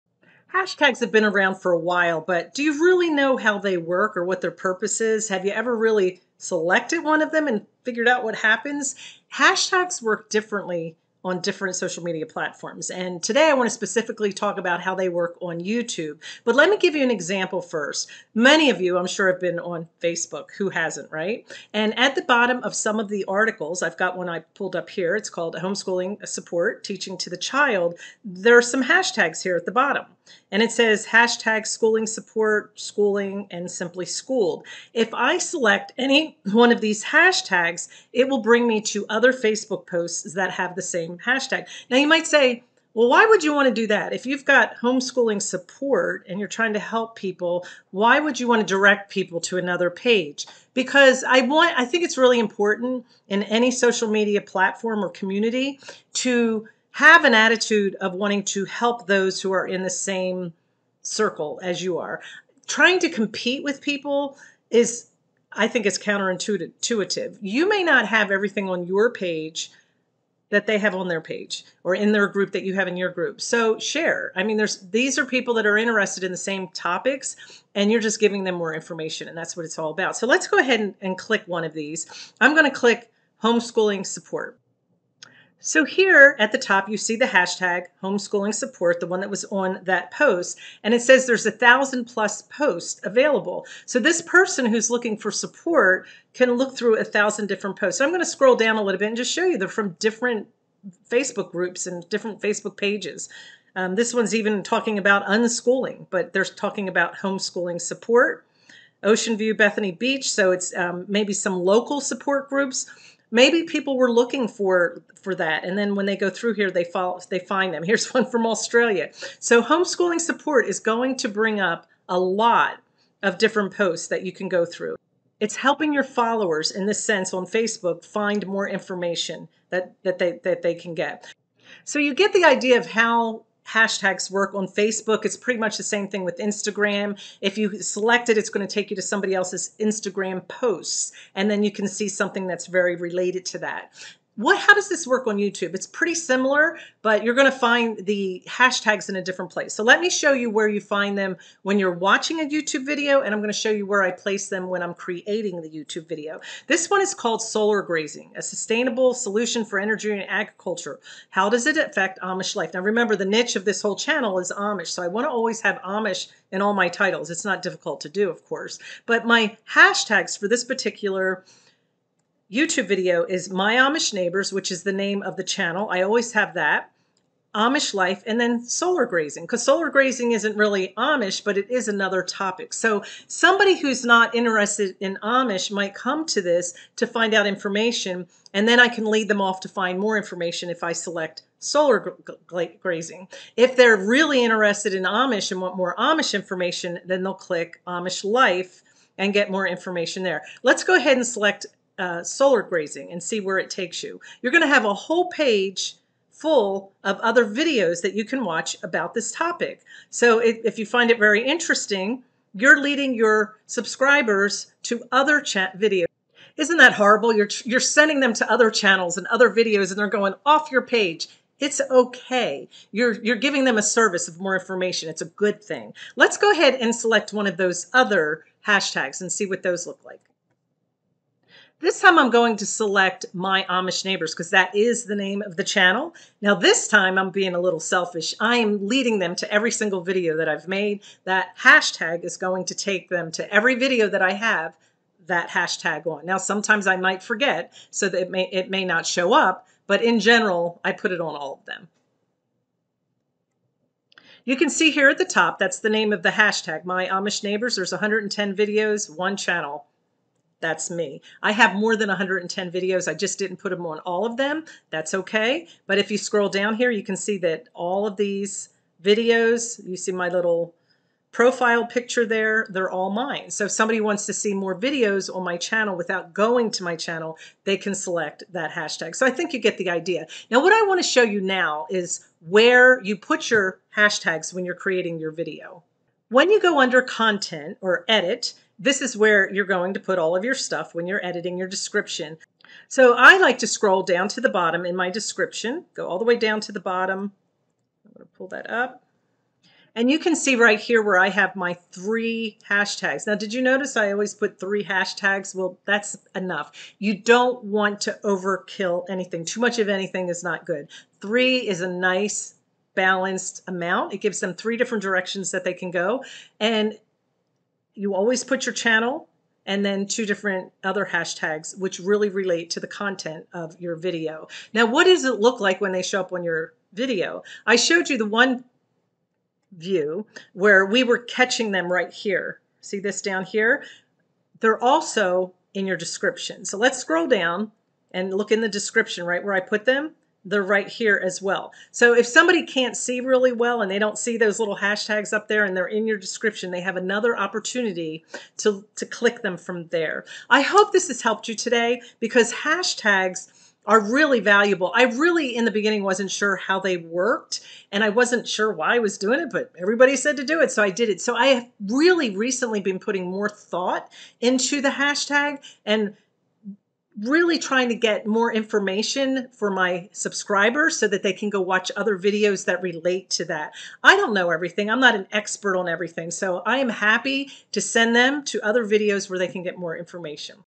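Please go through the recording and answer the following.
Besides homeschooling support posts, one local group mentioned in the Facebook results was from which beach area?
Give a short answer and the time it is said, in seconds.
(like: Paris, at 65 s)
Ocean View Bethany Beach, at 109 s.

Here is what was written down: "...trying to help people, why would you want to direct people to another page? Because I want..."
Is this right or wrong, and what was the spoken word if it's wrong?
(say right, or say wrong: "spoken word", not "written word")
right.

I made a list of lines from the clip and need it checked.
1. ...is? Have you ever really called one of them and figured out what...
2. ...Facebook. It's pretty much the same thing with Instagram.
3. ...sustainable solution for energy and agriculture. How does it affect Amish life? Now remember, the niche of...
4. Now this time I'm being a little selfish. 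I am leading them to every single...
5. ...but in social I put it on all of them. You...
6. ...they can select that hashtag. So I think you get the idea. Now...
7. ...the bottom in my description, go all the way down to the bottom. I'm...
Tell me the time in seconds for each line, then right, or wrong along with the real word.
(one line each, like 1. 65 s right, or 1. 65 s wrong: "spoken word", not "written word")
1. 5 s wrong: "selected", not "called"
2. 134 s right
3. 158 s right
4. 236 s right
5. 249 s wrong: "general", not "social"
6. 277 s right
7. 294 s right.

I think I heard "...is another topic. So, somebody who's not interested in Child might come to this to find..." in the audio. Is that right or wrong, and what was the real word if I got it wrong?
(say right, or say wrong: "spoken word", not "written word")
wrong: "Amish", not "Child".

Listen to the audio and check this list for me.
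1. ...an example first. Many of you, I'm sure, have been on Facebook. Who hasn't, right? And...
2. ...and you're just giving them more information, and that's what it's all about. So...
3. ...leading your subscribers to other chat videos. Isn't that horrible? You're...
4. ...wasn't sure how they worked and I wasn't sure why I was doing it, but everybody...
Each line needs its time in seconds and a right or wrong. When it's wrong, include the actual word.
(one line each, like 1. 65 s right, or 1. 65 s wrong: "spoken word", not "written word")
1. 17 s right
2. 77 s right
3. 212 s right
4. 356 s right.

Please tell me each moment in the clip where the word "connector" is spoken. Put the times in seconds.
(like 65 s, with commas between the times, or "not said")
not said.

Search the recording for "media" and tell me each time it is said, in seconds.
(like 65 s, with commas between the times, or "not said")
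12 s, 54 s.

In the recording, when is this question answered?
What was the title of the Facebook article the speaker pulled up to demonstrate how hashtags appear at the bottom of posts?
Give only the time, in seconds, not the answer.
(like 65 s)
25 s.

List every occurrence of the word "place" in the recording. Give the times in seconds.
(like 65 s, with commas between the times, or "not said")
149 s, 154 s.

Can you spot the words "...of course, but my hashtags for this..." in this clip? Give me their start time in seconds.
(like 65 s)
168 s.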